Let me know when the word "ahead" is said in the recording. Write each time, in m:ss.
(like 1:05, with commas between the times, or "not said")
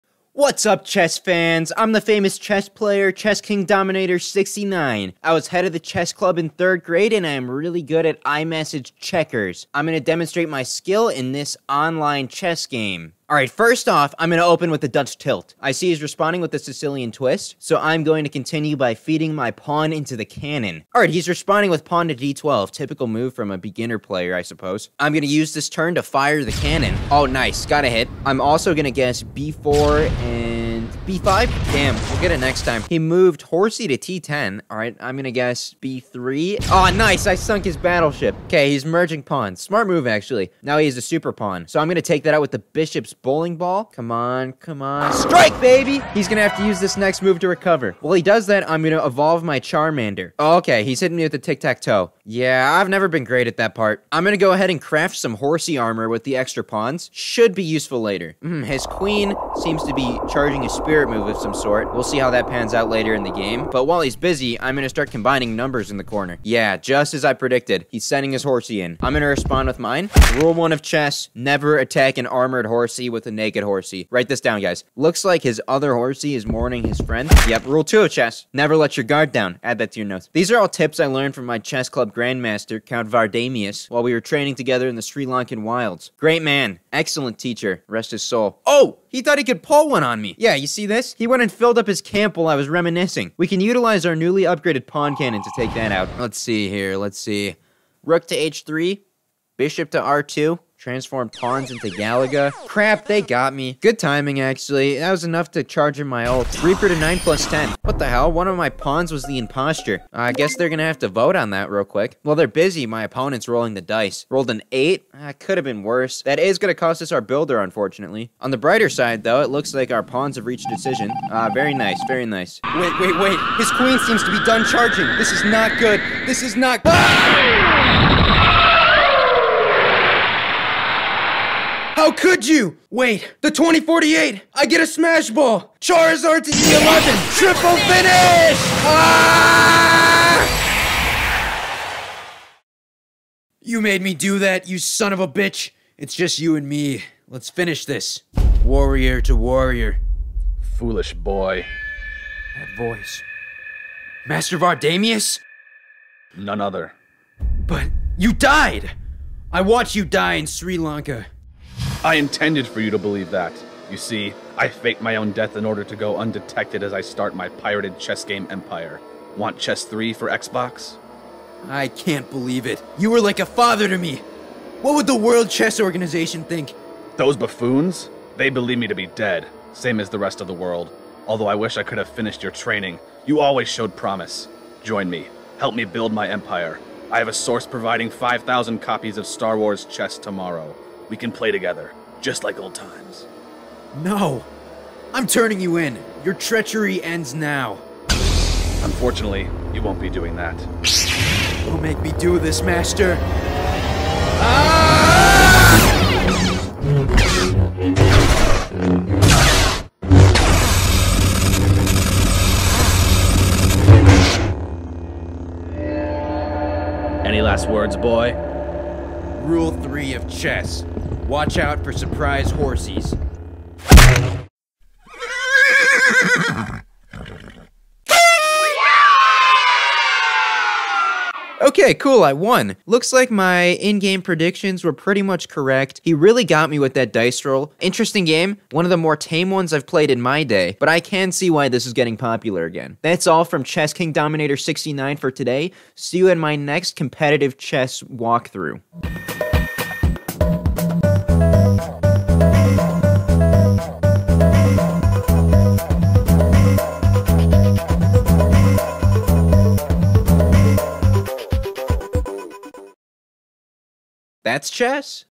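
0:54.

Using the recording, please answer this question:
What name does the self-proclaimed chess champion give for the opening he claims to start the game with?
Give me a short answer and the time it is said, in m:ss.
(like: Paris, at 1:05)
Dutch tilt, at 0:14.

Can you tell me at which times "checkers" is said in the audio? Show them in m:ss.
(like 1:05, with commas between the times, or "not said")
0:08.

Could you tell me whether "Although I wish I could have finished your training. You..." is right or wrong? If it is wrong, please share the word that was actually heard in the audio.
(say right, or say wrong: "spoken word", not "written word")
right.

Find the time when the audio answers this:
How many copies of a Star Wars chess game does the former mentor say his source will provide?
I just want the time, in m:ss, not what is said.
3:08.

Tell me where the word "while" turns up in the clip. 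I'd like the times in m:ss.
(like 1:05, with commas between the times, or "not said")
0:48, 1:03, 1:23, 1:32.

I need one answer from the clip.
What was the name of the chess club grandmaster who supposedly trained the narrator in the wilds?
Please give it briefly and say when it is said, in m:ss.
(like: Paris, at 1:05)
Count Vardamius, at 1:22.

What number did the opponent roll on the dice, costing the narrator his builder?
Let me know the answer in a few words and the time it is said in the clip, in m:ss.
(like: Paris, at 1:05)
8, at 1:54.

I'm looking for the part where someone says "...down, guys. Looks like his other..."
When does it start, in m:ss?
1:14.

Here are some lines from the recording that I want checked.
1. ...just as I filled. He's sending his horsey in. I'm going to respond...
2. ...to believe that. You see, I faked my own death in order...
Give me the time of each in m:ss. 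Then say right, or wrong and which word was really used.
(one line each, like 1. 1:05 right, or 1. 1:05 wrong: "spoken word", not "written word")
1. 1:06 wrong: "predicted", not "filled"
2. 2:42 right.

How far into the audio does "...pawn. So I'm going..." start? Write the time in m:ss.
0:41.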